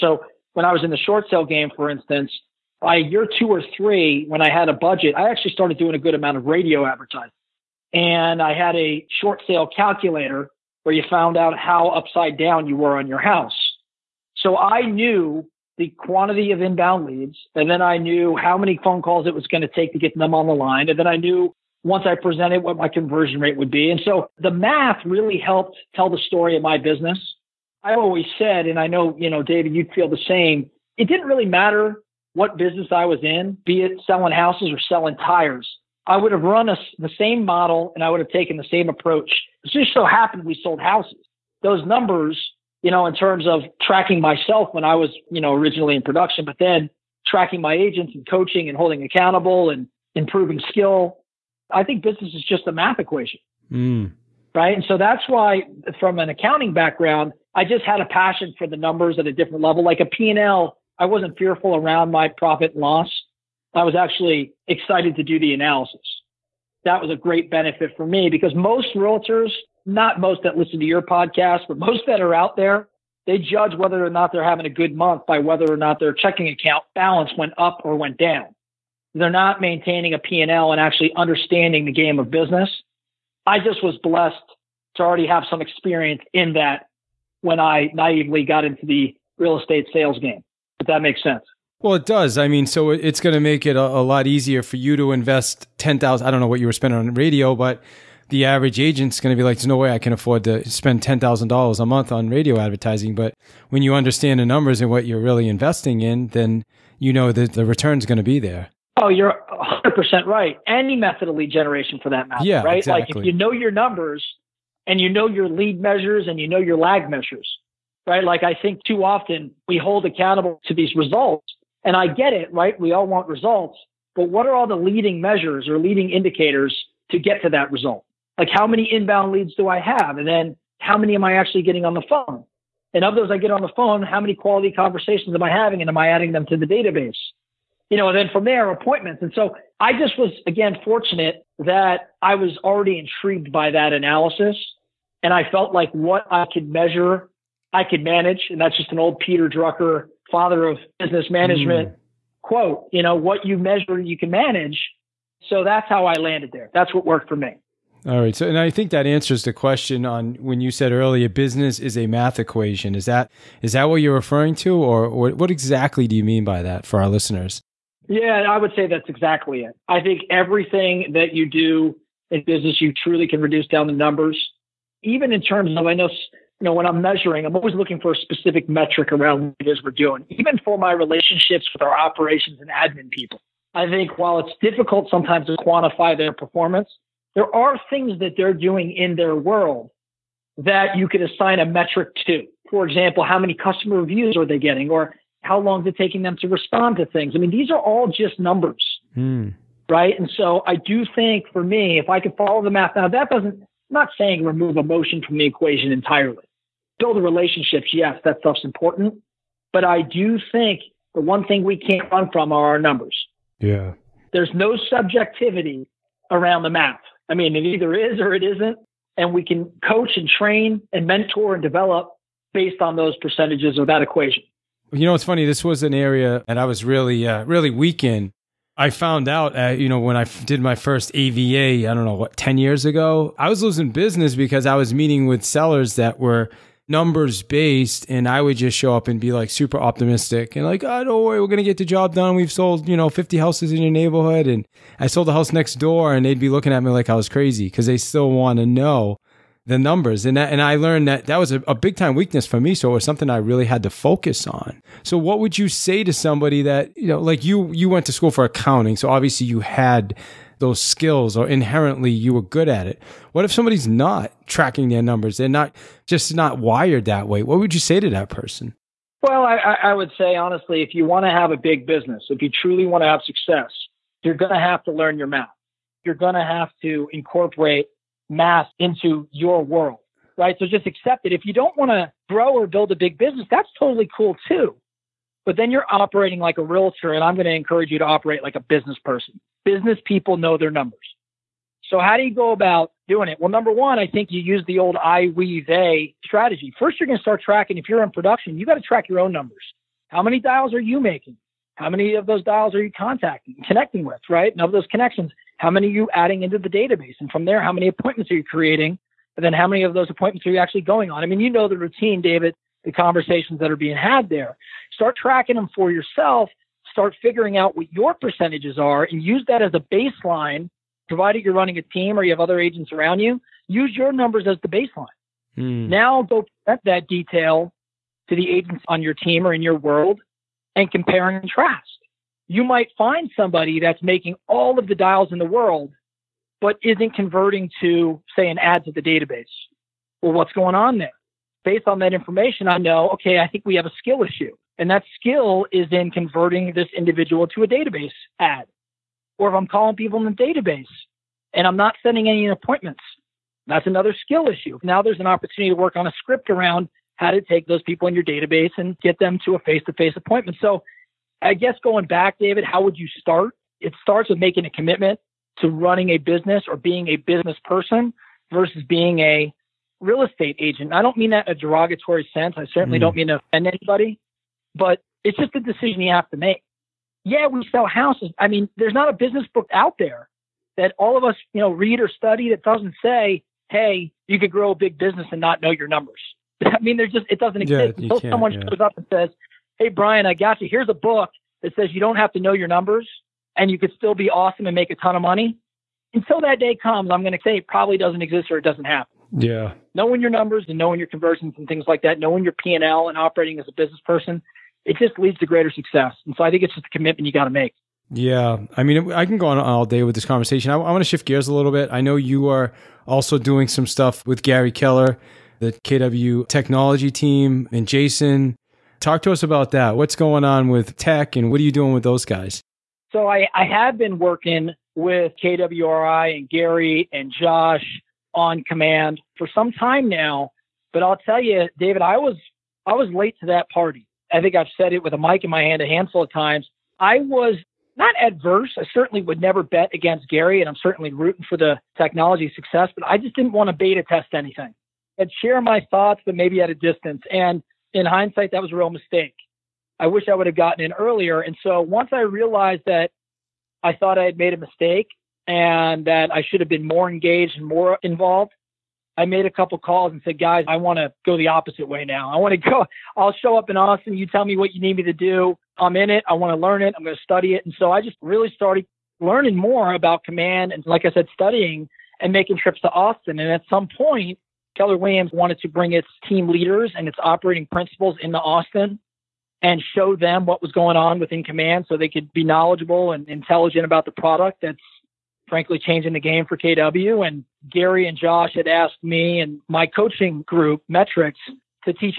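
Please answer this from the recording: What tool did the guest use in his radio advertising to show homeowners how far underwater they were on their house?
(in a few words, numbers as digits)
short sale calculator.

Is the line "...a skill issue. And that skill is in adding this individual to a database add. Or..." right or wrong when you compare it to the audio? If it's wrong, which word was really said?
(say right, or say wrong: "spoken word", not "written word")
wrong: "converting", not "adding".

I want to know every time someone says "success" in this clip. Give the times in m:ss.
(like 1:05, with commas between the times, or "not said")
4:33, 6:45, 7:22.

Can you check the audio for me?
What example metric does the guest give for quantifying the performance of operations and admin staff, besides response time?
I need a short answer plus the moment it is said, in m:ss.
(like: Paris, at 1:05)
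customer reviews, at 3:13.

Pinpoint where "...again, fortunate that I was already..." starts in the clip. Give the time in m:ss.
2:20.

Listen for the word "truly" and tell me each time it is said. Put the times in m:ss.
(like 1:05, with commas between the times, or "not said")
2:52, 4:32.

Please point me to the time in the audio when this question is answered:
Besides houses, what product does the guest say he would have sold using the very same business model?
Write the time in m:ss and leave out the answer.
0:34.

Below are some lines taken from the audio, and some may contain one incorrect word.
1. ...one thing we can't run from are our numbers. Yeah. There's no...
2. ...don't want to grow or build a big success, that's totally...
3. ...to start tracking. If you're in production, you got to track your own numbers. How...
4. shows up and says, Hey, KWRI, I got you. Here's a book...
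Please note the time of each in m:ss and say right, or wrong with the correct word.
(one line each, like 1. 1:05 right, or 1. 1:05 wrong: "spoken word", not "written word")
1. 3:31 right
2. 4:41 wrong: "business", not "success"
3. 4:57 right
4. 6:28 wrong: "Brian", not "KWRI".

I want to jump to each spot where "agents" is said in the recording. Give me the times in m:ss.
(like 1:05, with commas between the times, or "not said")
0:47, 1:38, 5:22, 5:28, 6:10.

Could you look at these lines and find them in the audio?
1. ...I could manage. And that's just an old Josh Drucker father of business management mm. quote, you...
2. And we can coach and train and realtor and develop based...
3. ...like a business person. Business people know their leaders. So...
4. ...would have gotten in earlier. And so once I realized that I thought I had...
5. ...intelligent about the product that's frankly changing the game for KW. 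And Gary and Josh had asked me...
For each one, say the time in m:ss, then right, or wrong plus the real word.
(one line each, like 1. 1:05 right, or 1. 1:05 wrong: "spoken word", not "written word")
1. 2:27 wrong: "Peter", not "Josh"
2. 3:39 wrong: "mentor", not "realtor"
3. 4:48 wrong: "numbers", not "leaders"
4. 7:30 right
5. 8:03 right.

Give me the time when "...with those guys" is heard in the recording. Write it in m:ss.
7:01.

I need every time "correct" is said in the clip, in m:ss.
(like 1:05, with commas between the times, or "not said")
not said.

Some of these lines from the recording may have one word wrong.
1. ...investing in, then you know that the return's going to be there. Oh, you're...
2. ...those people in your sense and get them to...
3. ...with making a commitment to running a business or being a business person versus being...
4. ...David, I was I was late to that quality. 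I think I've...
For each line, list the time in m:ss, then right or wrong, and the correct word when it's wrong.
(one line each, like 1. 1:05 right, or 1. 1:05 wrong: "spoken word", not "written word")
1. 1:45 right
2. 5:57 wrong: "database", not "sense"
3. 6:04 right
4. 7:11 wrong: "party", not "quality".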